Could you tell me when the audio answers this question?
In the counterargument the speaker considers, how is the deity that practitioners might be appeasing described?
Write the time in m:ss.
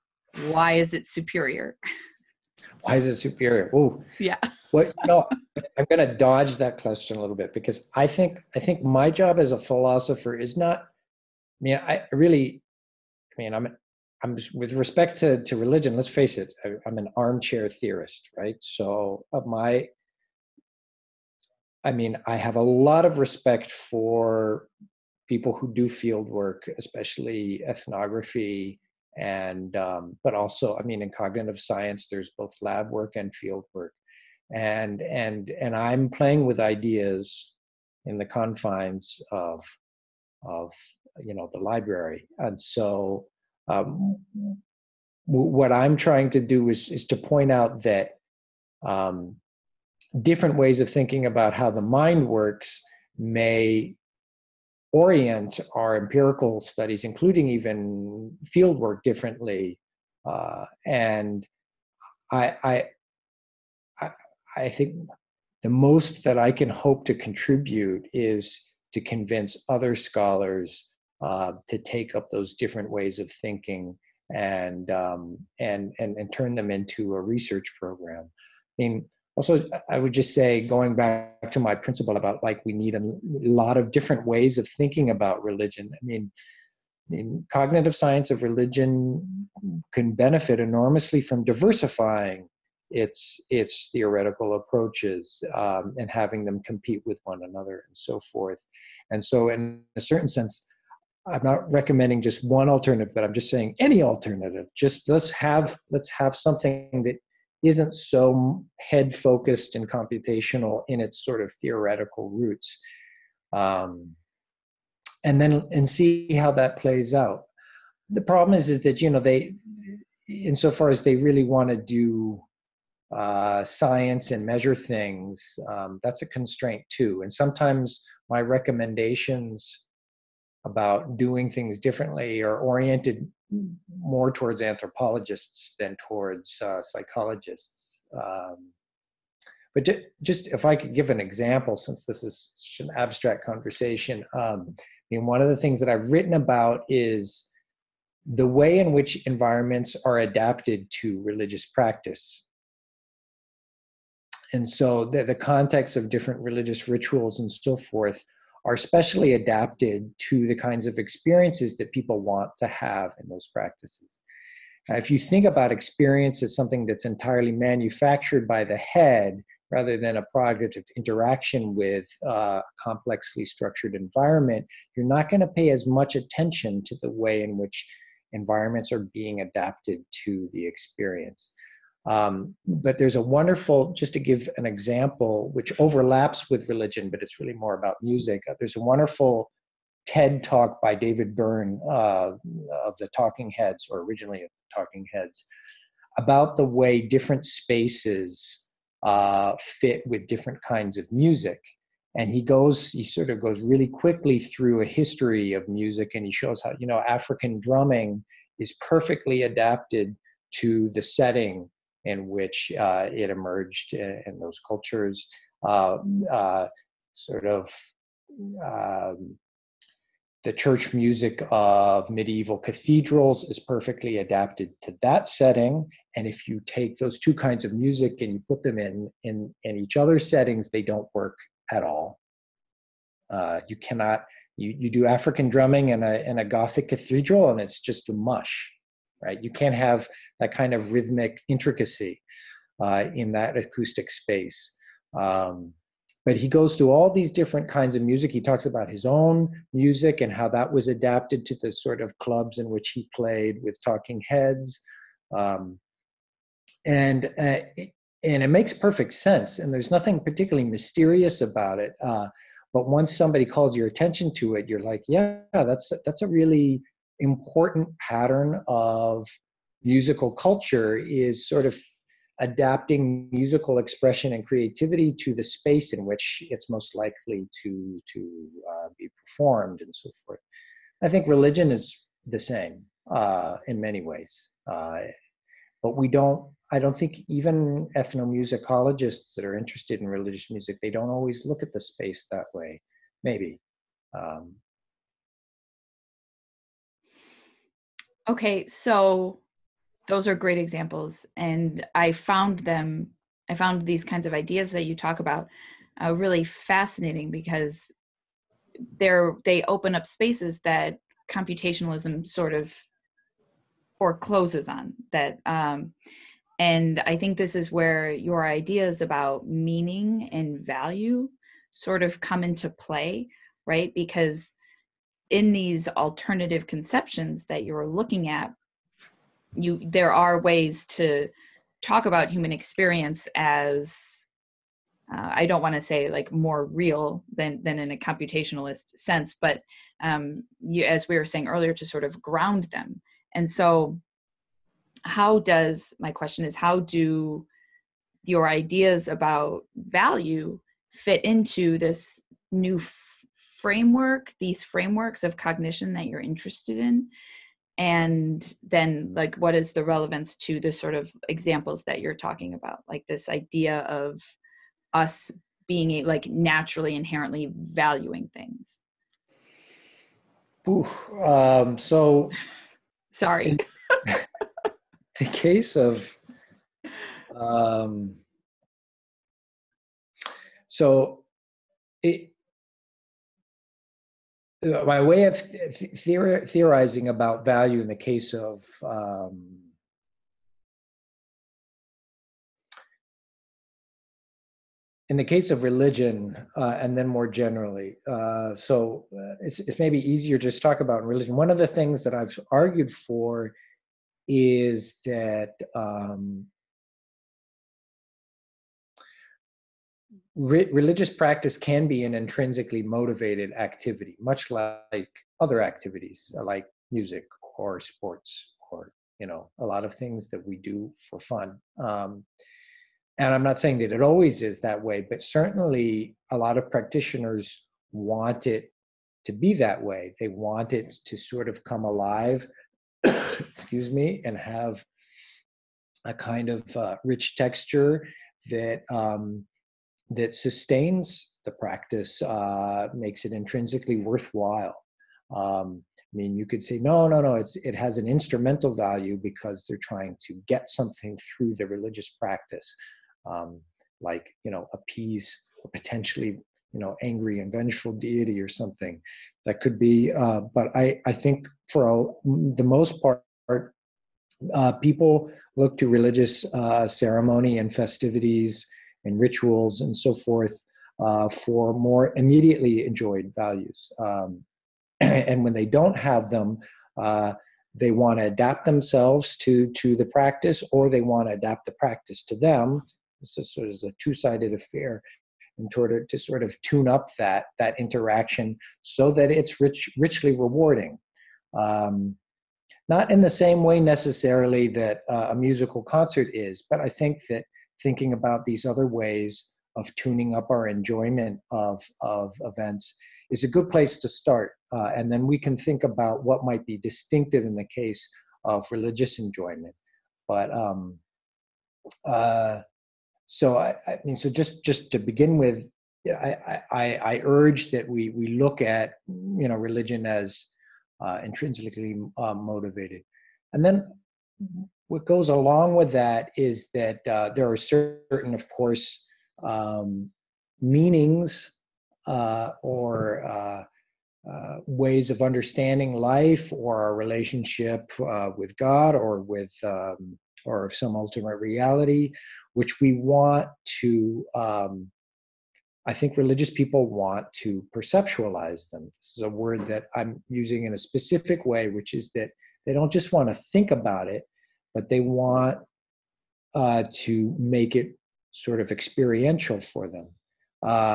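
7:37.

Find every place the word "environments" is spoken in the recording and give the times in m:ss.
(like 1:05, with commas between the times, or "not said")
2:29, 2:53, 2:58.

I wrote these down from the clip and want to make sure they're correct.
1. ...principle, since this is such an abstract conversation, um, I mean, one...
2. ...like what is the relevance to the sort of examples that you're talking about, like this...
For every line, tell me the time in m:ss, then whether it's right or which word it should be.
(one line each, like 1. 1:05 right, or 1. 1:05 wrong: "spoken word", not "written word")
1. 2:21 wrong: "example", not "principle"
2. 5:59 right.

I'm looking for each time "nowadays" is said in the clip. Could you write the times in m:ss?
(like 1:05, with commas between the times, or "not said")
not said.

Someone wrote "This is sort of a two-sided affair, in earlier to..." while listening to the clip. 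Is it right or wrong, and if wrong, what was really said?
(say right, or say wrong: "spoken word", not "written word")
wrong: "order", not "earlier".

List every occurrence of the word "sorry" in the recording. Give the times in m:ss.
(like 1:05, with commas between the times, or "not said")
6:13.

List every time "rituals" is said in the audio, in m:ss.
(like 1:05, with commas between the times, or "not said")
2:36, 7:49.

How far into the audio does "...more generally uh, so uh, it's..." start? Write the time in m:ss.
6:37.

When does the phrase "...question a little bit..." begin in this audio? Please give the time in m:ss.
0:06.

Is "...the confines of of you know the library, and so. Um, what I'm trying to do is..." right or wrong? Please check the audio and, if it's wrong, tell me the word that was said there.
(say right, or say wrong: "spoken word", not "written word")
right.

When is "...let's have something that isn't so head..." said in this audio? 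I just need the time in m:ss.
1:45.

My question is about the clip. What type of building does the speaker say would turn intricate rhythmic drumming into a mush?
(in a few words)
Gothic cathedral.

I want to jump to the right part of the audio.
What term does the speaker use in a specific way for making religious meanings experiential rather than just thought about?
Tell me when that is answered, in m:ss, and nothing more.
9:07.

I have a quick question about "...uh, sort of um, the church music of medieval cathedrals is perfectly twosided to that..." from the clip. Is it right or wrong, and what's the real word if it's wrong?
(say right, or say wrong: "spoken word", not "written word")
wrong: "adapted", not "twosided".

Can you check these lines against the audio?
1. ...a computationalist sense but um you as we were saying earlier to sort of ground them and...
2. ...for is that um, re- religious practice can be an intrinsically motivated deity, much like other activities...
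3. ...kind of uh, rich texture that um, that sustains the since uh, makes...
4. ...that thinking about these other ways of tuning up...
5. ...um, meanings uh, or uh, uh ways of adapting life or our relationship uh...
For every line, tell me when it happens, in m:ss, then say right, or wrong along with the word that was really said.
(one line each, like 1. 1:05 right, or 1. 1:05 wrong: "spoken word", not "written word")
1. 5:37 right
2. 6:42 wrong: "activity", not "deity"
3. 7:16 wrong: "practice", not "since"
4. 8:17 right
5. 8:49 wrong: "understanding", not "adapting".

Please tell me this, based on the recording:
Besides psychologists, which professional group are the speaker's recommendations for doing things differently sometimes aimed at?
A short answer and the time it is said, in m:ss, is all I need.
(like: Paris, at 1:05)
anthropologists, at 2:14.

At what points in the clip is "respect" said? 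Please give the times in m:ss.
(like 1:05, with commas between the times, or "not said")
0:14, 0:23.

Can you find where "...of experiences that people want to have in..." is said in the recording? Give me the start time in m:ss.
2:40.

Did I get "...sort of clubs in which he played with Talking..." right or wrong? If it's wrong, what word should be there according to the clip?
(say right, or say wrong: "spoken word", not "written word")
right.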